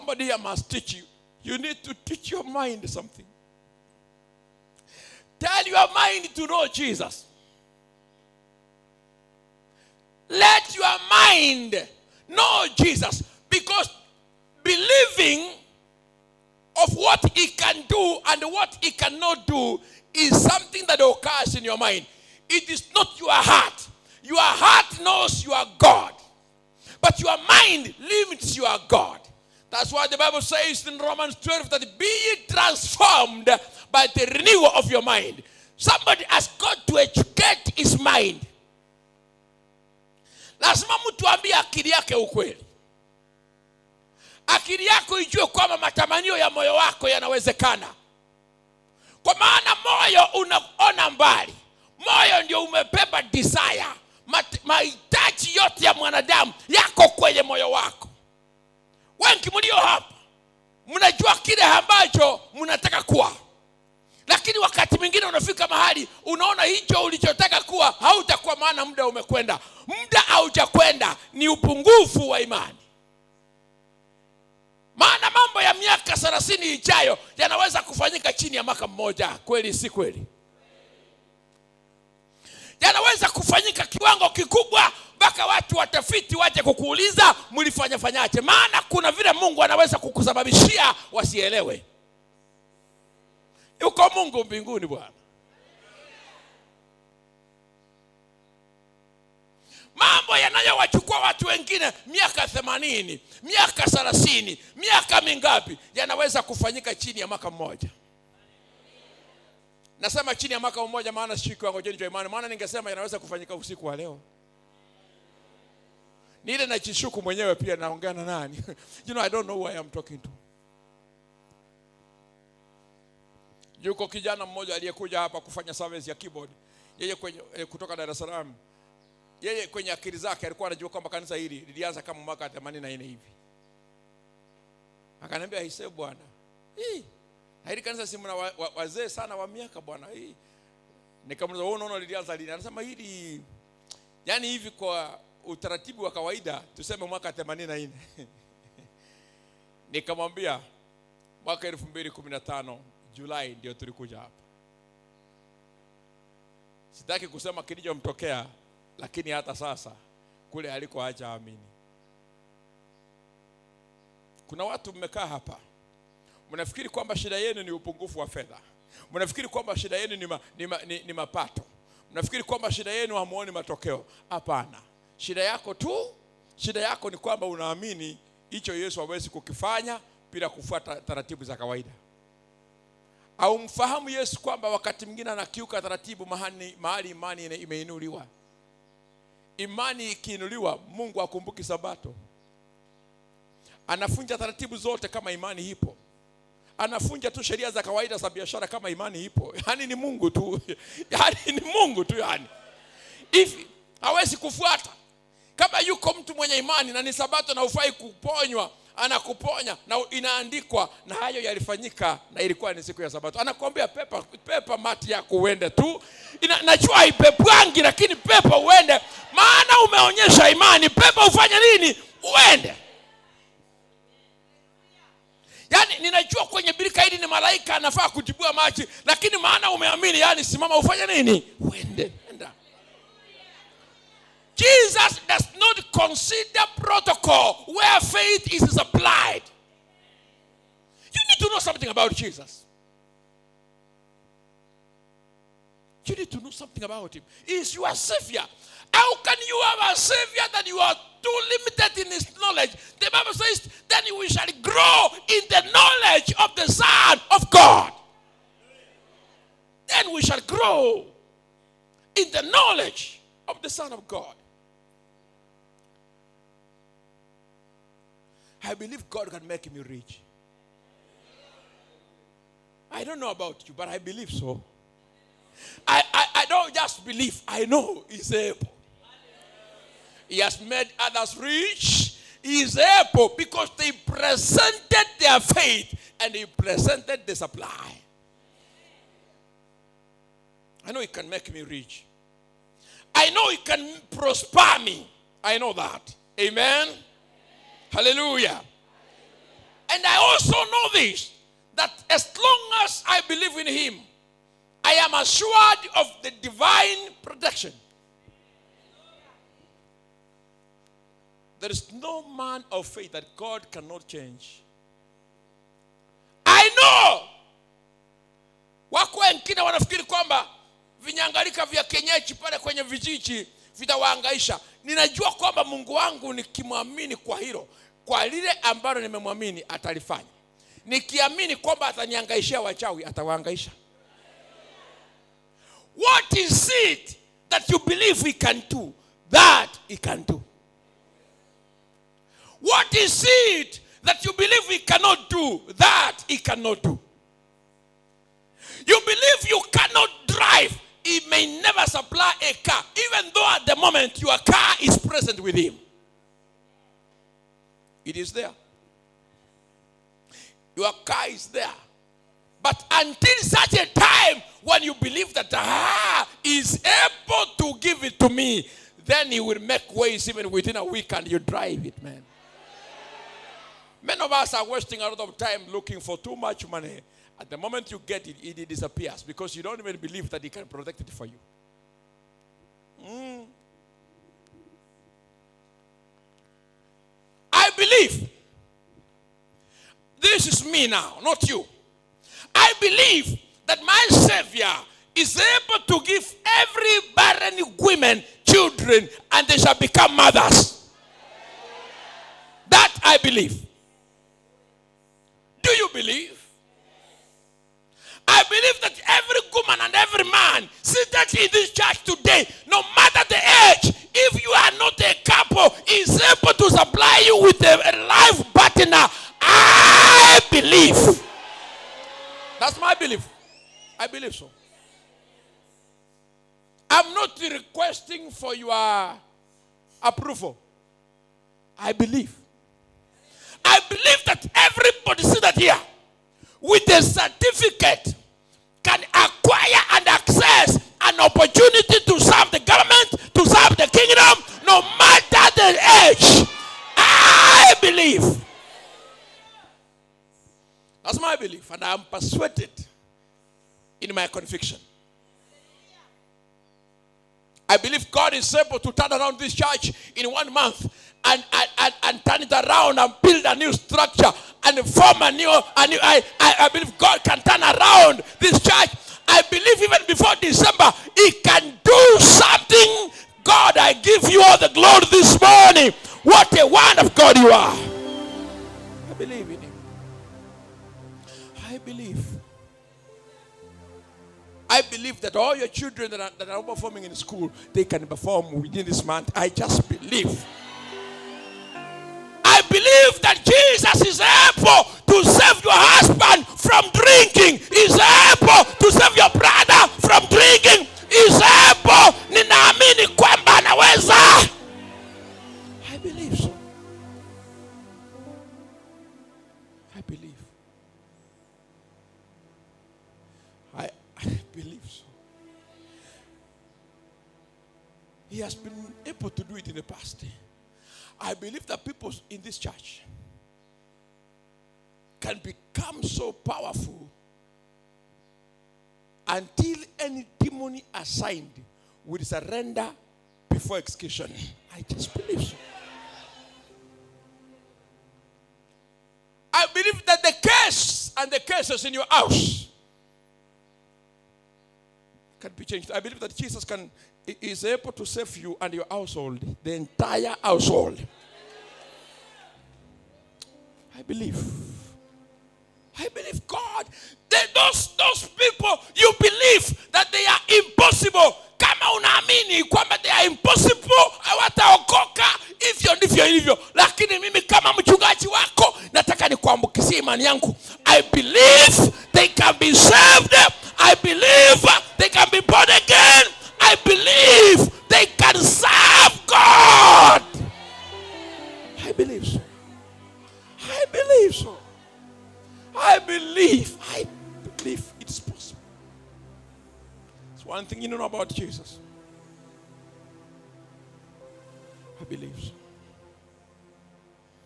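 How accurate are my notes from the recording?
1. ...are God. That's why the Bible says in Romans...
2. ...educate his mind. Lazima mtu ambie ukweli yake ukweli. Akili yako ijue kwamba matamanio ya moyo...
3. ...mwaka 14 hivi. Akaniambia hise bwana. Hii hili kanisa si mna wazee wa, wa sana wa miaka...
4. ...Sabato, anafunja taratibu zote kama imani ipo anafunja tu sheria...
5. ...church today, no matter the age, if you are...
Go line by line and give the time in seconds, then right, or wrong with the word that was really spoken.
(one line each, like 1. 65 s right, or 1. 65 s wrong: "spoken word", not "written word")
1. 28 s right
2. 36 s wrong: "akili", not "ukweli"
3. 132 s wrong: "84", not "14"
4. 191 s right
5. 411 s right.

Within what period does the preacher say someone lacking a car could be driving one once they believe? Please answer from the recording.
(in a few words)
a week.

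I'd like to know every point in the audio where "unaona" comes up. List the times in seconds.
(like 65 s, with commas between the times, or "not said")
50 s, 66 s, 141 s.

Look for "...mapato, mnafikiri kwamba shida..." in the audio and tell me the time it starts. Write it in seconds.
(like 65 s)
171 s.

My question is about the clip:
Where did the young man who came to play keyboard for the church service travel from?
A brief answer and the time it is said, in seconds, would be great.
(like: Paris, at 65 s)
Dar es Salaam, at 127 s.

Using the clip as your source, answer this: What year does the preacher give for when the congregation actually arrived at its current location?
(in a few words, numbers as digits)
2015.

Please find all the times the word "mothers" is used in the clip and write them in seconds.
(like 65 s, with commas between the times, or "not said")
400 s.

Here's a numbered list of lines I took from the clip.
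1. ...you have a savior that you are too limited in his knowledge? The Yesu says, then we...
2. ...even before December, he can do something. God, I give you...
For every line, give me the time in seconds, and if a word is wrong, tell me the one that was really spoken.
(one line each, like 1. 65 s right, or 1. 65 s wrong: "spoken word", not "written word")
1. 249 s wrong: "Bible", not "Yesu"
2. 469 s right.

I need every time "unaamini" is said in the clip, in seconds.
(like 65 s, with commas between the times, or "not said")
177 s, 561 s.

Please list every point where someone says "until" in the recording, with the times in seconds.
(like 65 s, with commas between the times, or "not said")
362 s, 529 s.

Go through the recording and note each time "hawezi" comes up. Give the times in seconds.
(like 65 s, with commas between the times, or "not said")
178 s, 203 s.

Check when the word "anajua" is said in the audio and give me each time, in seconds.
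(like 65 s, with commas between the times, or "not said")
130 s.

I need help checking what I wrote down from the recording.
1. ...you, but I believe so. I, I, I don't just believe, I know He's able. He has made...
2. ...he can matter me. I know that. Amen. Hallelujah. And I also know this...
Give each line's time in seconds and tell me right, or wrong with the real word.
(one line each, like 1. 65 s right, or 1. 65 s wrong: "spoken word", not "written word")
1. 273 s right
2. 293 s wrong: "prosper", not "matter".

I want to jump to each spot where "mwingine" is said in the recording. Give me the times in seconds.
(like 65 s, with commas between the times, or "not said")
64 s, 185 s.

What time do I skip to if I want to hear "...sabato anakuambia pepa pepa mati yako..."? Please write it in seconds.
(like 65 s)
213 s.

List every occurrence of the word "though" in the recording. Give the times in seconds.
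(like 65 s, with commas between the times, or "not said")
353 s.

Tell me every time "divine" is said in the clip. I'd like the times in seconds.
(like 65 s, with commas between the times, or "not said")
306 s.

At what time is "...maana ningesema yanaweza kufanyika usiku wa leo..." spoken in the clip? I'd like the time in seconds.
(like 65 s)
112 s.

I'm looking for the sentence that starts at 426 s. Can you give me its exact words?
I'm not requesting for your approval.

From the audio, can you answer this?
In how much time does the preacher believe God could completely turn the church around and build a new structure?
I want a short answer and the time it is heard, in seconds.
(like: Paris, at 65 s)
one month, at 460 s.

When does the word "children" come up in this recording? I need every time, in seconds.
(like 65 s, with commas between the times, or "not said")
398 s, 485 s.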